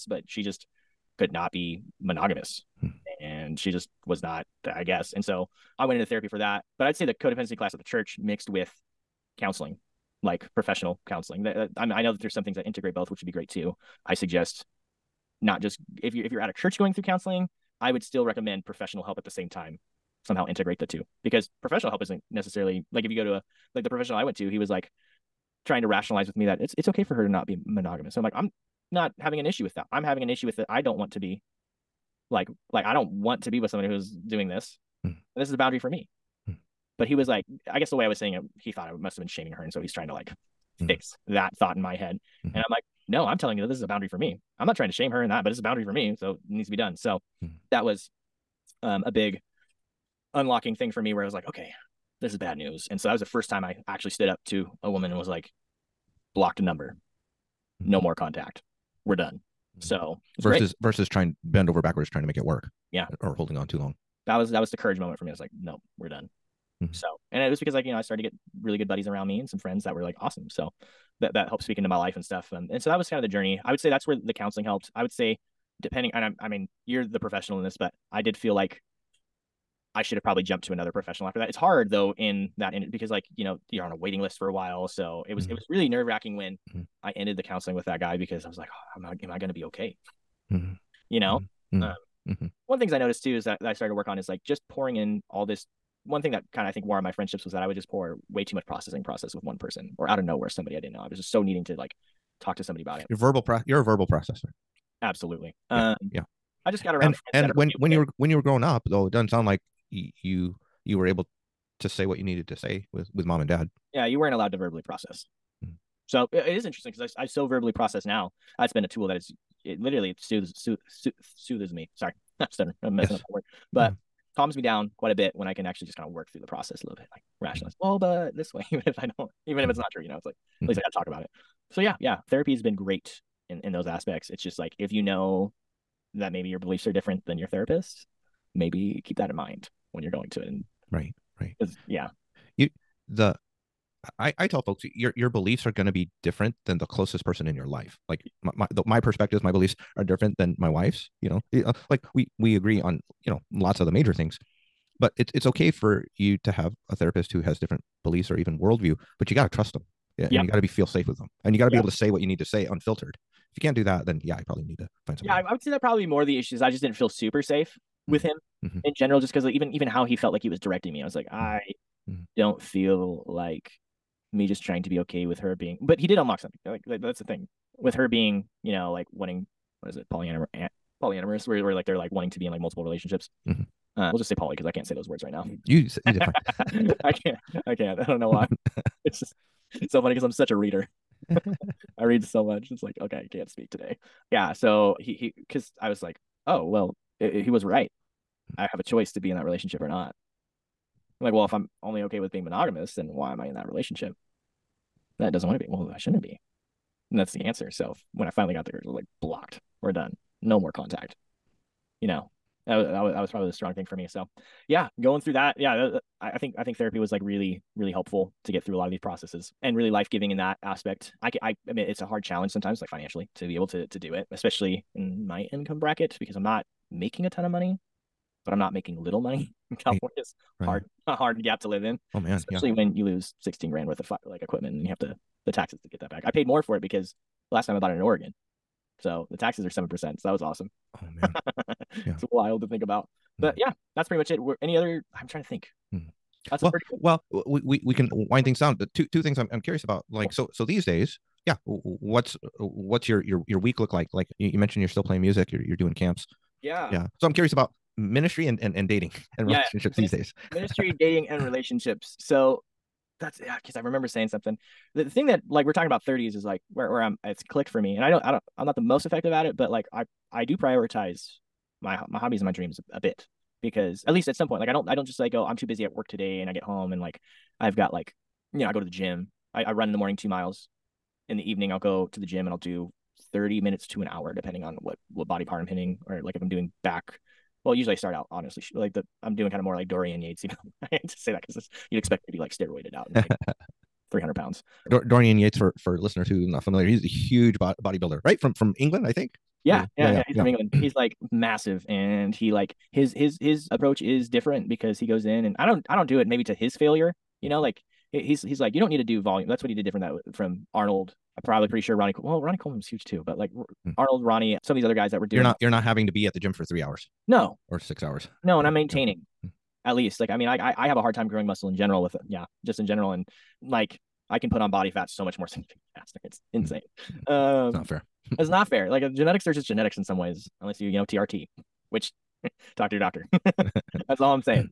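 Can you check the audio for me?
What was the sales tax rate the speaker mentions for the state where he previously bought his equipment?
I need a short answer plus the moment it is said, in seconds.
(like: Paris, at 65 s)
7%, at 239 s.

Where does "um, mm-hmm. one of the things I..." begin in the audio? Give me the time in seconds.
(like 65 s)
92 s.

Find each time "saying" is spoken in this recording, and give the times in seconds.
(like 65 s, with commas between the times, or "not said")
38 s, 264 s.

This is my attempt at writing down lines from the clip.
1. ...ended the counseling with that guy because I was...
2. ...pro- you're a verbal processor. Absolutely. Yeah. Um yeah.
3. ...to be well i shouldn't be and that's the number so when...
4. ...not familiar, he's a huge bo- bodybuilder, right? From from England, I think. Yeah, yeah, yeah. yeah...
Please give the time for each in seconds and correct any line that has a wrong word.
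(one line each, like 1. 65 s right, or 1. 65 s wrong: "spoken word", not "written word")
1. 87 s right
2. 103 s right
3. 205 s wrong: "answer", not "number"
4. 296 s right.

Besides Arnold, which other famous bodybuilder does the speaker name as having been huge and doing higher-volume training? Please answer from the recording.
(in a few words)
Ronnie Coleman.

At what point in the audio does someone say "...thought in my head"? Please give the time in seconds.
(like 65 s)
41 s.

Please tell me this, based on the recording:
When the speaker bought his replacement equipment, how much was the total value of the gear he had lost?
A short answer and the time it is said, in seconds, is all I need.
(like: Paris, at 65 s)
16 grand, at 233 s.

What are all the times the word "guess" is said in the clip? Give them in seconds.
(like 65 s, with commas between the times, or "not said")
4 s, 37 s.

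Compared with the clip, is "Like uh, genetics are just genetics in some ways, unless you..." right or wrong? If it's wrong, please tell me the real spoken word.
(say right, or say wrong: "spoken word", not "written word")
right.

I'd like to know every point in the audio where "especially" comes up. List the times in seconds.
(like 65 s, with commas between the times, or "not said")
224 s, 232 s.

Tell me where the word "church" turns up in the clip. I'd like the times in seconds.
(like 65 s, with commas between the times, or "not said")
7 s, 16 s.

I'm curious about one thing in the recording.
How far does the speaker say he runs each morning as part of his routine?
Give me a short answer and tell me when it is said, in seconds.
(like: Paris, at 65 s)
2 miles, at 280 s.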